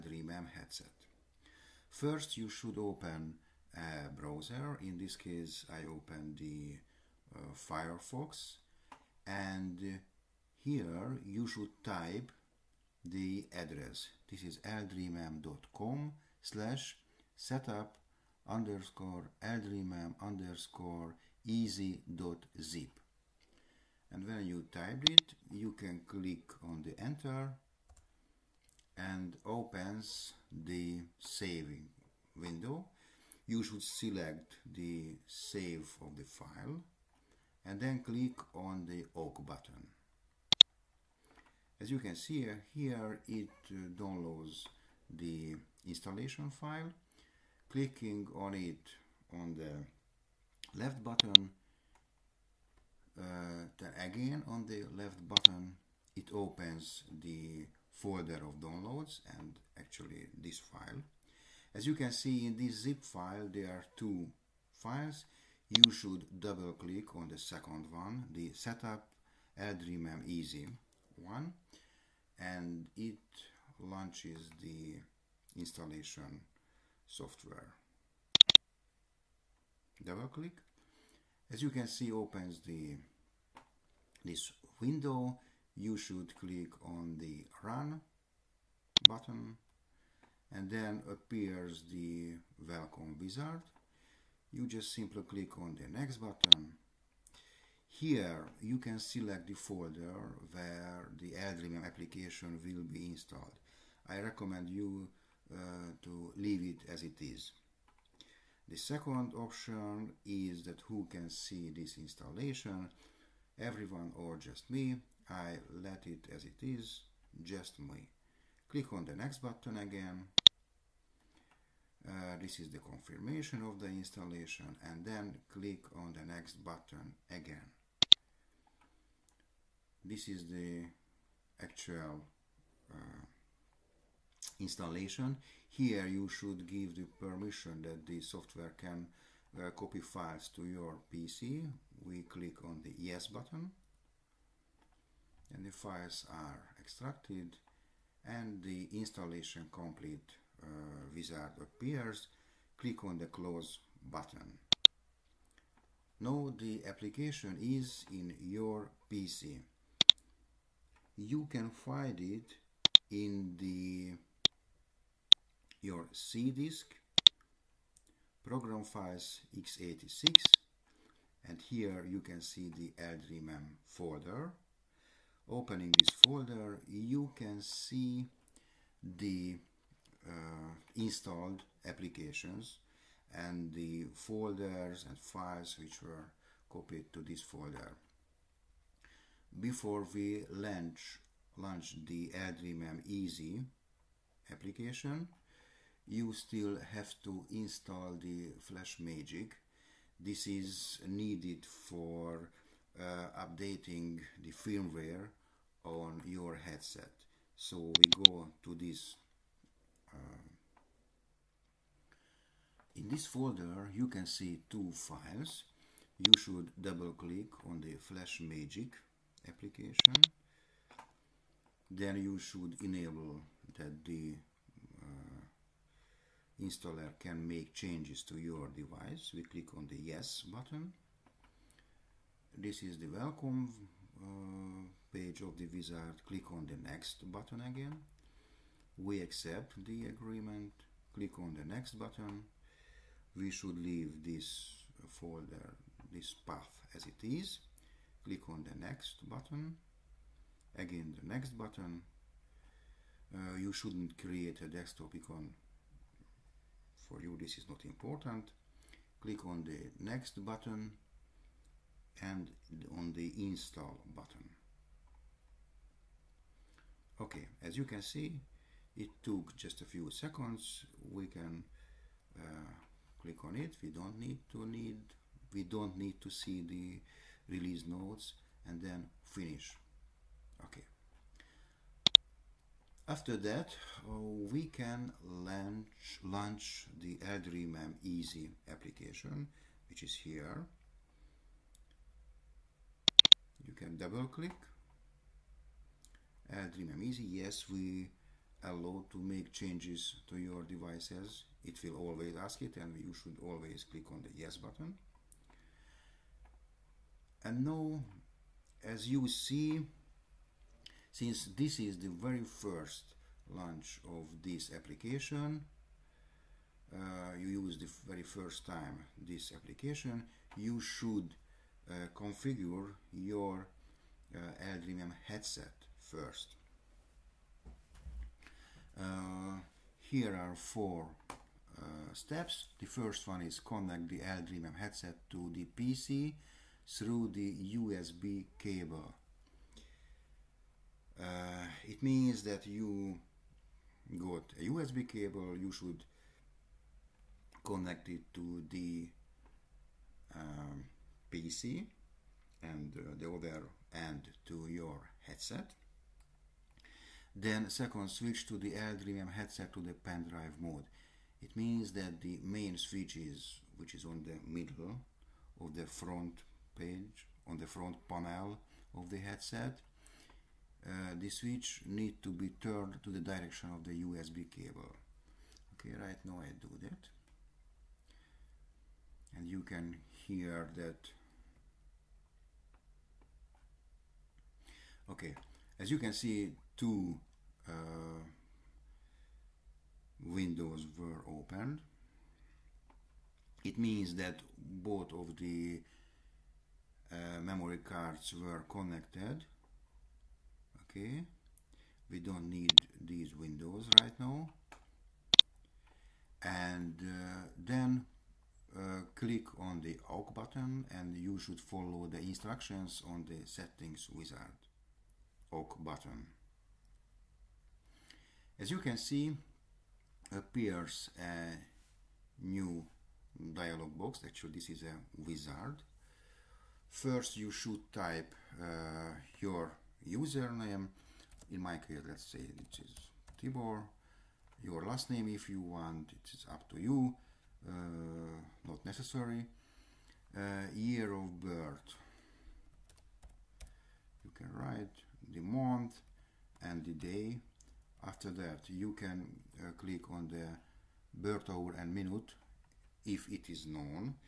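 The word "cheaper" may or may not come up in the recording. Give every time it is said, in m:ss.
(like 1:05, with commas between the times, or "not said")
not said.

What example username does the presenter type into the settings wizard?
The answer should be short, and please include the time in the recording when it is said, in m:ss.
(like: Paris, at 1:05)
Tibor, at 7:13.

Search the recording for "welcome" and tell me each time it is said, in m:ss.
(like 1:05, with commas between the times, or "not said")
1:32, 3:53.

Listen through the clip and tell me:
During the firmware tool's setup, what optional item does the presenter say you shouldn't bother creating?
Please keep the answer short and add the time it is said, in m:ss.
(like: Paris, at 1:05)
Desktop icon, at 4:14.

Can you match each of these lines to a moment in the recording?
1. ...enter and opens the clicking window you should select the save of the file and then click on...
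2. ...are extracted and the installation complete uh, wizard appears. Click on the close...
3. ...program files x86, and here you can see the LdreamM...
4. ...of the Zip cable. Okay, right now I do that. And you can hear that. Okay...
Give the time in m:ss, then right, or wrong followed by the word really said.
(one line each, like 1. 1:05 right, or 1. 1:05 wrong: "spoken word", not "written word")
1. 0:26 wrong: "saving", not "clicking"
2. 2:26 right
3. 2:48 right
4. 6:13 wrong: "USB", not "Zip".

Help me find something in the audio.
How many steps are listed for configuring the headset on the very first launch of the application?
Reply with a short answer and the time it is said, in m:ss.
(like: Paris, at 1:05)
4, at 5:30.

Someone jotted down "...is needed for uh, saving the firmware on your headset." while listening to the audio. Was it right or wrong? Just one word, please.
wrong.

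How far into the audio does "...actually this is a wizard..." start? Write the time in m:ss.
7:04.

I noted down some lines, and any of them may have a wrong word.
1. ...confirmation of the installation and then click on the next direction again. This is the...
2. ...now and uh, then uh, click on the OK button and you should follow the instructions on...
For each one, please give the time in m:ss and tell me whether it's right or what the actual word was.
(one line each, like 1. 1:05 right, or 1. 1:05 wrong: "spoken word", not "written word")
1. 2:02 wrong: "button", not "direction"
2. 6:44 right.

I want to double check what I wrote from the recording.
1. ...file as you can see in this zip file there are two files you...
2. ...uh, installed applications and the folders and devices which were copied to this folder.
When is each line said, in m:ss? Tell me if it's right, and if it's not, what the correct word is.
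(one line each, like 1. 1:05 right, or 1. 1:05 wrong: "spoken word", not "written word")
1. 1:00 right
2. 3:00 wrong: "files", not "devices".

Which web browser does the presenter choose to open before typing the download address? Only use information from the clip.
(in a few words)
Firefox.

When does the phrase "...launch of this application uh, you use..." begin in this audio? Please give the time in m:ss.
5:13.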